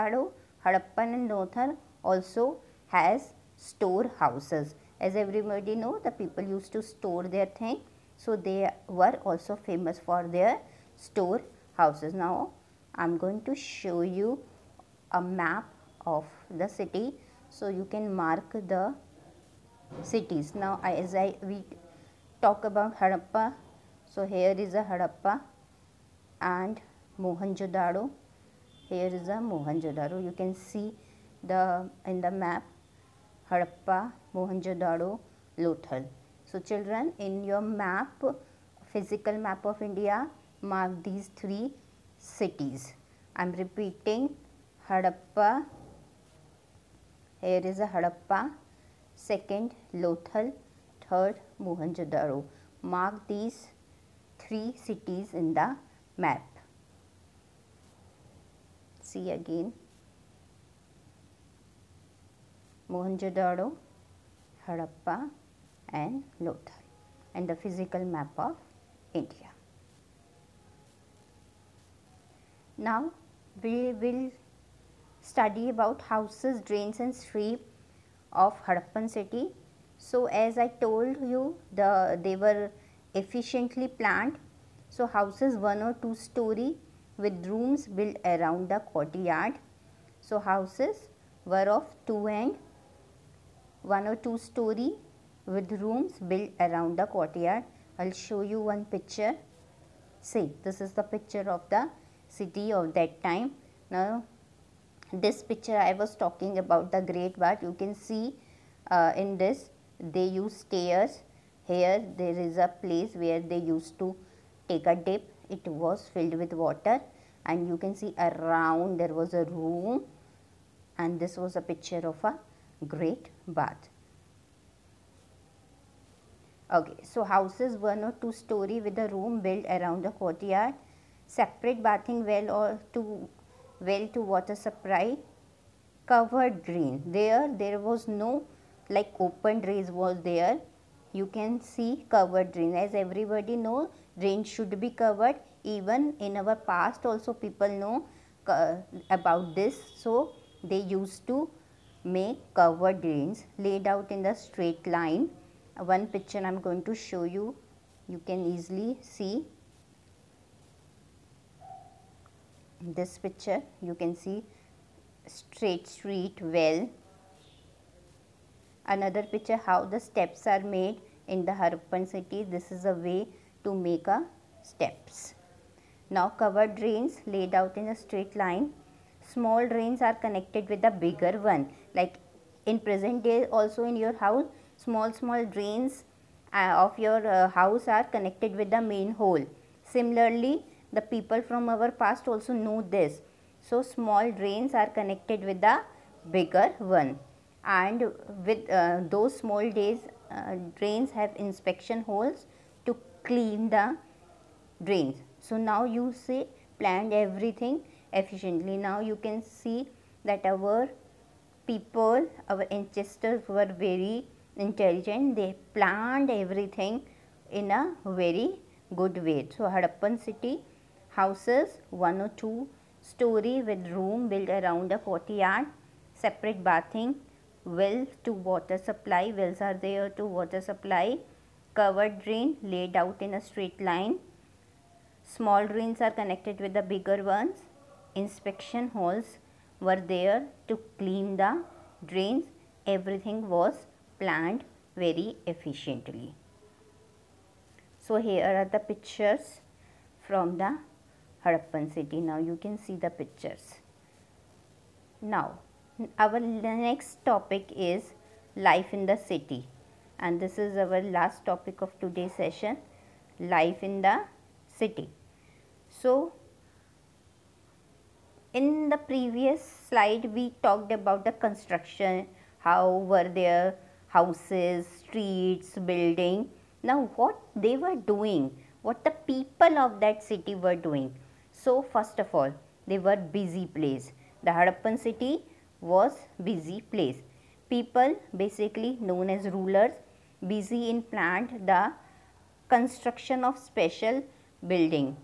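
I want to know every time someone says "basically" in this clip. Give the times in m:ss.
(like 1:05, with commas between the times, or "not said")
4:48.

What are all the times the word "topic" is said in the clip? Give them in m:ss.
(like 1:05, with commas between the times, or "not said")
4:17, 4:21.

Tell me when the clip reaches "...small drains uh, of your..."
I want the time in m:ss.
3:05.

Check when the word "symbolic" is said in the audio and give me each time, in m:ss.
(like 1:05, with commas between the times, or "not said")
not said.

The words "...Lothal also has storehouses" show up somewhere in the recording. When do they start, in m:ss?
0:01.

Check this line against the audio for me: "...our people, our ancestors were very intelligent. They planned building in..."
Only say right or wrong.
wrong.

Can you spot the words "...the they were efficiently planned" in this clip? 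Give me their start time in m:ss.
1:21.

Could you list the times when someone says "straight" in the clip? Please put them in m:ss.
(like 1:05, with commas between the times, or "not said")
2:34, 2:45, 2:58, 3:53.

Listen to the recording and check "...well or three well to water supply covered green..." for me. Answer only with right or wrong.
wrong.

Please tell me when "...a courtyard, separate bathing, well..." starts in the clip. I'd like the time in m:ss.
3:44.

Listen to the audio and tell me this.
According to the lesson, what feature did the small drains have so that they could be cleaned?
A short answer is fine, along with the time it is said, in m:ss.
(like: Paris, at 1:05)
Inspection holes, at 3:21.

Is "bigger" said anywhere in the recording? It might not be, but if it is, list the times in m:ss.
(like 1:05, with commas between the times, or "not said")
3:01, 3:16, 3:56.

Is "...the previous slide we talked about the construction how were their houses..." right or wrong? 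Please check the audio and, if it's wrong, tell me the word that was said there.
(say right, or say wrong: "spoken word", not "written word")
right.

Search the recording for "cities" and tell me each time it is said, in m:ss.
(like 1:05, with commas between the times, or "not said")
0:20, 0:42, 0:54.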